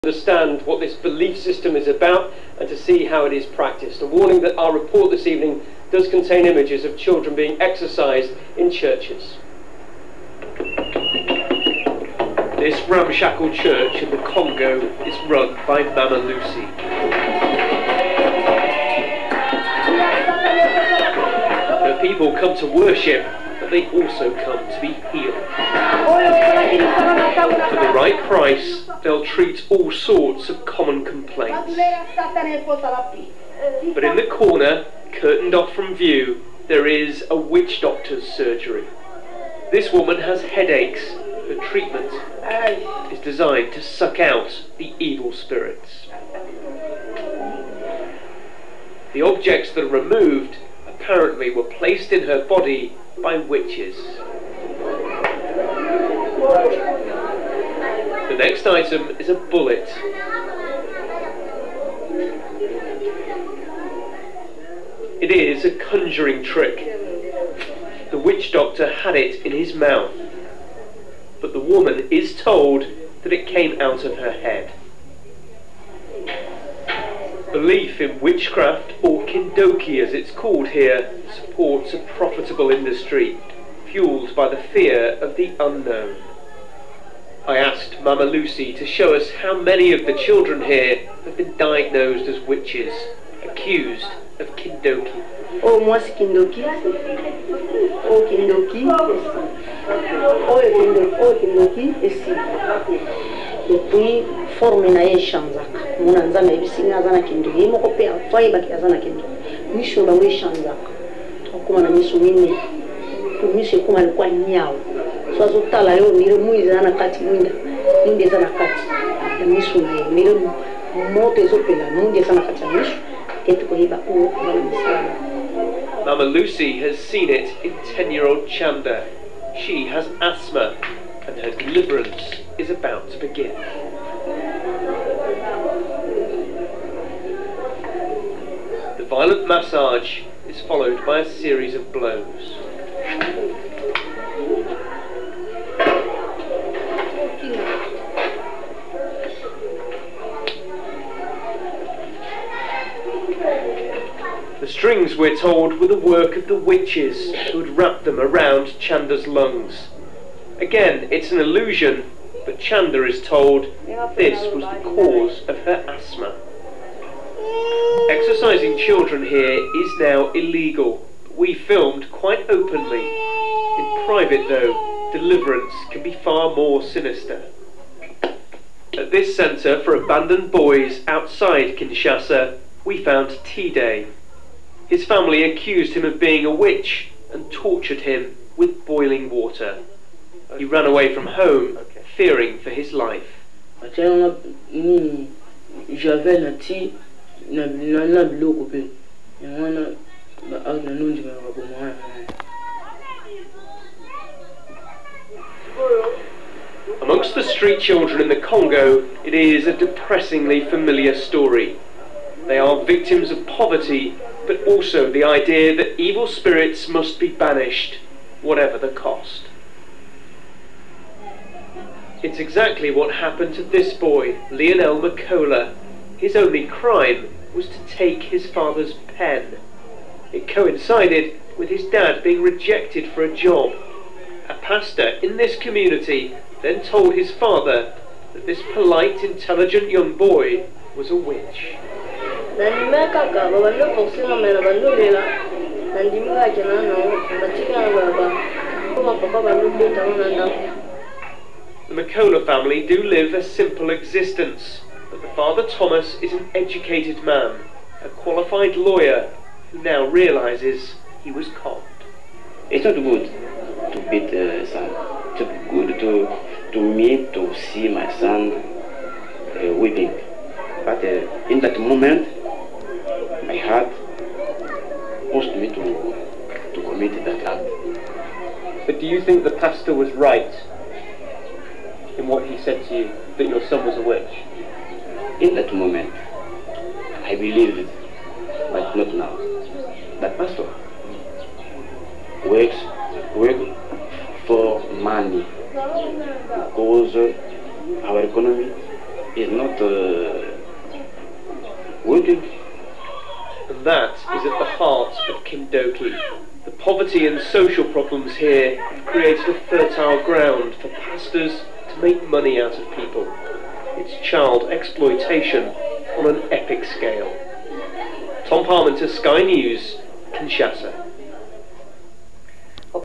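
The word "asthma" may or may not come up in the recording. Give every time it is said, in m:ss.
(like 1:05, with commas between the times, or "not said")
2:10, 2:45.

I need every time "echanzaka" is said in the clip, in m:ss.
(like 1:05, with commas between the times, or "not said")
1:45, 1:50.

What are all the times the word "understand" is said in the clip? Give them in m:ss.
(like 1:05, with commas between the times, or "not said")
0:00.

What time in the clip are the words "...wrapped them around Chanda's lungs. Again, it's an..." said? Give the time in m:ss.
2:37.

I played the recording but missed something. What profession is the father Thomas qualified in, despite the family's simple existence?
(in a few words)
lawyer.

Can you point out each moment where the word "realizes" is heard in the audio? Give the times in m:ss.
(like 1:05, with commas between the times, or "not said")
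4:20.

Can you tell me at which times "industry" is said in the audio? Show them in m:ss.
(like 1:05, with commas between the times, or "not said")
1:22.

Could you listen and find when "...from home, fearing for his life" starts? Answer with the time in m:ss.
3:11.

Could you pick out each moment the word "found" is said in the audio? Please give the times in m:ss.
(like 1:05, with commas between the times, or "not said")
3:03.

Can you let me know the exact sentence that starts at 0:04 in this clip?
A warning that our report this evening does contain images of children being exercised in churches.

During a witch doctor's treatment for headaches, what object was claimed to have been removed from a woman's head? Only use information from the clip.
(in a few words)
A bullet.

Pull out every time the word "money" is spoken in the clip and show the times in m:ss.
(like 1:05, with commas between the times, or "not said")
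4:54, 5:12.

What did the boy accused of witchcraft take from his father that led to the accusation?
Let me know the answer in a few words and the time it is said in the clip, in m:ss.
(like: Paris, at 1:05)
his father's pen, at 3:48.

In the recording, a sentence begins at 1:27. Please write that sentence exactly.
I asked Mama Lucy to show us how many of the children here have been diagnosed as witches, accused of kindoki.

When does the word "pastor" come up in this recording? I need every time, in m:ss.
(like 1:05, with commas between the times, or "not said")
3:54, 4:39, 4:50, 5:10.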